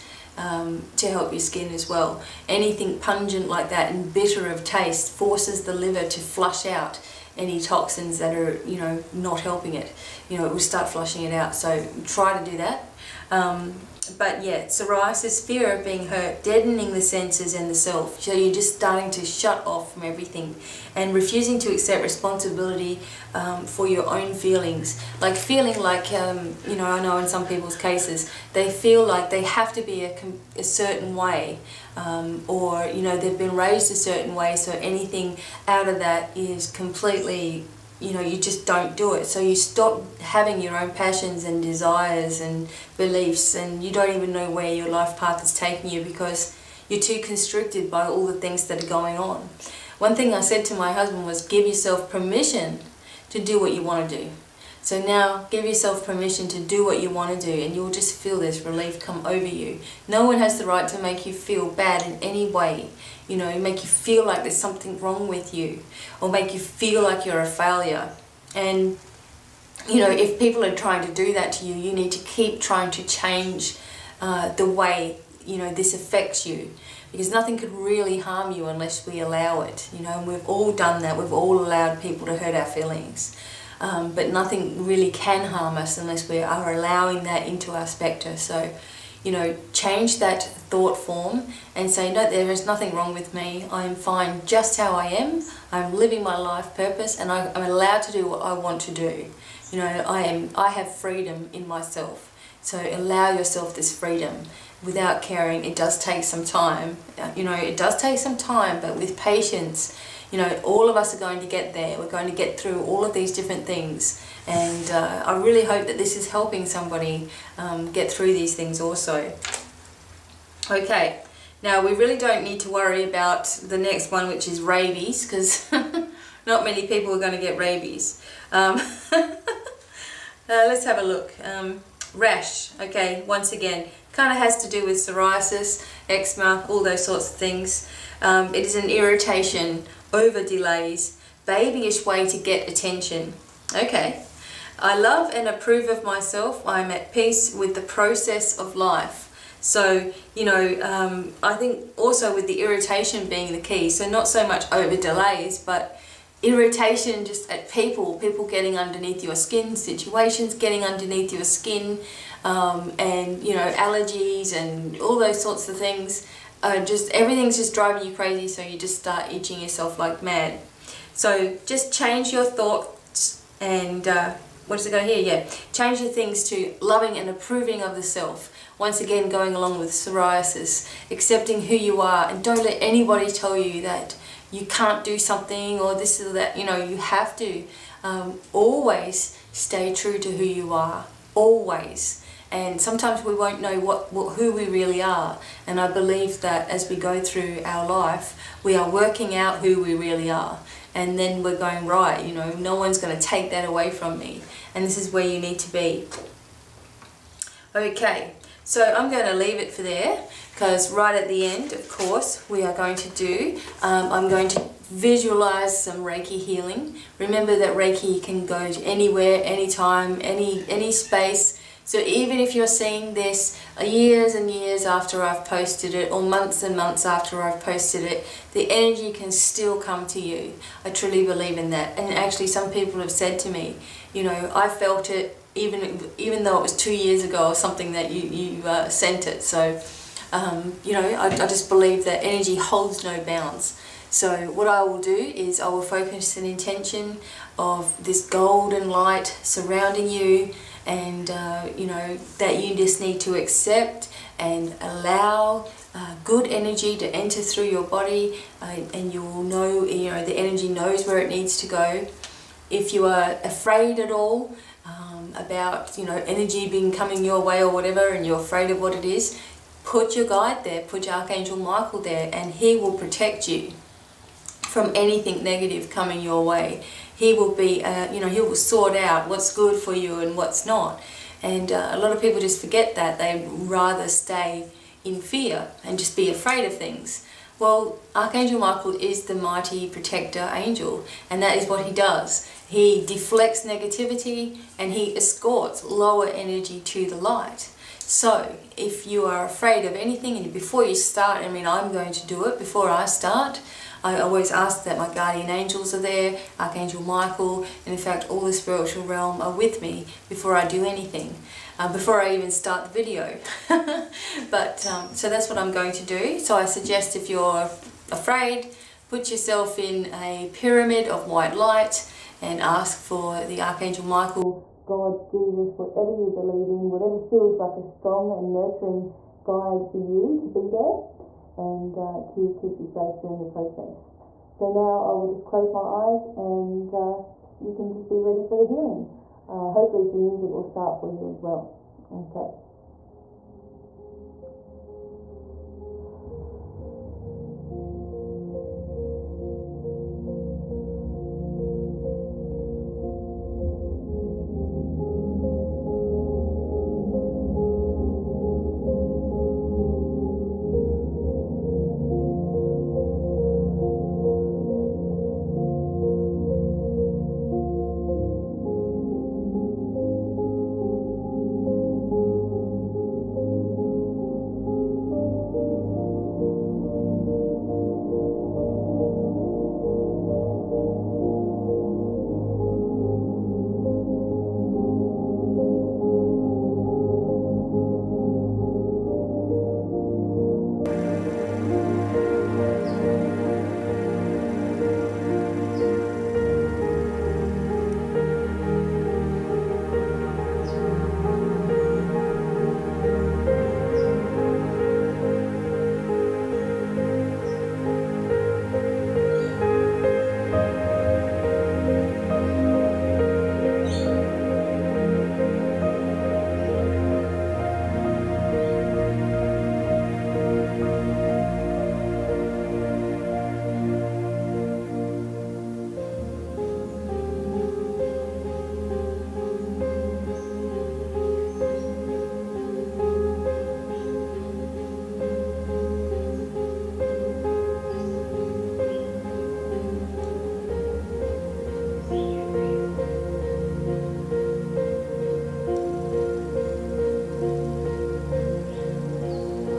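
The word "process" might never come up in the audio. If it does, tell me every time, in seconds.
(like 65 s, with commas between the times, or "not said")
147 s, 333 s.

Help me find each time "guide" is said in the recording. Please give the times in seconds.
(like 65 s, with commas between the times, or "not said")
270 s, 329 s.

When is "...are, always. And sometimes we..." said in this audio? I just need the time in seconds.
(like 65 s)
190 s.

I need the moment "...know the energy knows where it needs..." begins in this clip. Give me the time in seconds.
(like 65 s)
260 s.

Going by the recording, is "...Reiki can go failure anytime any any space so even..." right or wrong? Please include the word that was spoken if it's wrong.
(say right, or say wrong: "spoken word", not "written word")
wrong: "anywhere", not "failure".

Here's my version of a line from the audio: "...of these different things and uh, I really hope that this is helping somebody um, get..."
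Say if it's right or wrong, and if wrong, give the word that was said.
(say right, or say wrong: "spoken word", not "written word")
right.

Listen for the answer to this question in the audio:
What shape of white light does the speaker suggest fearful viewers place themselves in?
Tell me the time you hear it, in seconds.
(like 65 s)
320 s.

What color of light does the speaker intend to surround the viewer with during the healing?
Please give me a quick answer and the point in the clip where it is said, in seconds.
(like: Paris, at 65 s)
Golden, at 248 s.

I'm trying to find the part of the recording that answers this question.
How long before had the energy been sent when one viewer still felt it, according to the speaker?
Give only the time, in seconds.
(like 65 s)
236 s.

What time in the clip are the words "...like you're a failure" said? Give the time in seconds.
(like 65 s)
67 s.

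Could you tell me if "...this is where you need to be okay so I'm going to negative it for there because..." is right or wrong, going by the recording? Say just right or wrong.
wrong.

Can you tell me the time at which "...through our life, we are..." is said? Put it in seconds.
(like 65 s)
197 s.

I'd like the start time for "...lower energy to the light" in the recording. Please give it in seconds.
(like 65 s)
295 s.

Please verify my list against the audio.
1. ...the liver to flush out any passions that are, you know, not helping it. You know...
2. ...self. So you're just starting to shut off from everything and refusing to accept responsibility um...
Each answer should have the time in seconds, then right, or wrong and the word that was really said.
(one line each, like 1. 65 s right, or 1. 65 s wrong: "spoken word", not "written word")
1. 5 s wrong: "toxins", not "passions"
2. 17 s right.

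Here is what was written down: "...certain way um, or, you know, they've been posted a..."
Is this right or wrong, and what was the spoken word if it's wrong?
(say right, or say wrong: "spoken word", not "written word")
wrong: "raised", not "posted".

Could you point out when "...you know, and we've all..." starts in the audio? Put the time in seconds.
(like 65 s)
79 s.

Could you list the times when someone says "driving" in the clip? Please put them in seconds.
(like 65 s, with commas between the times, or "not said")
167 s.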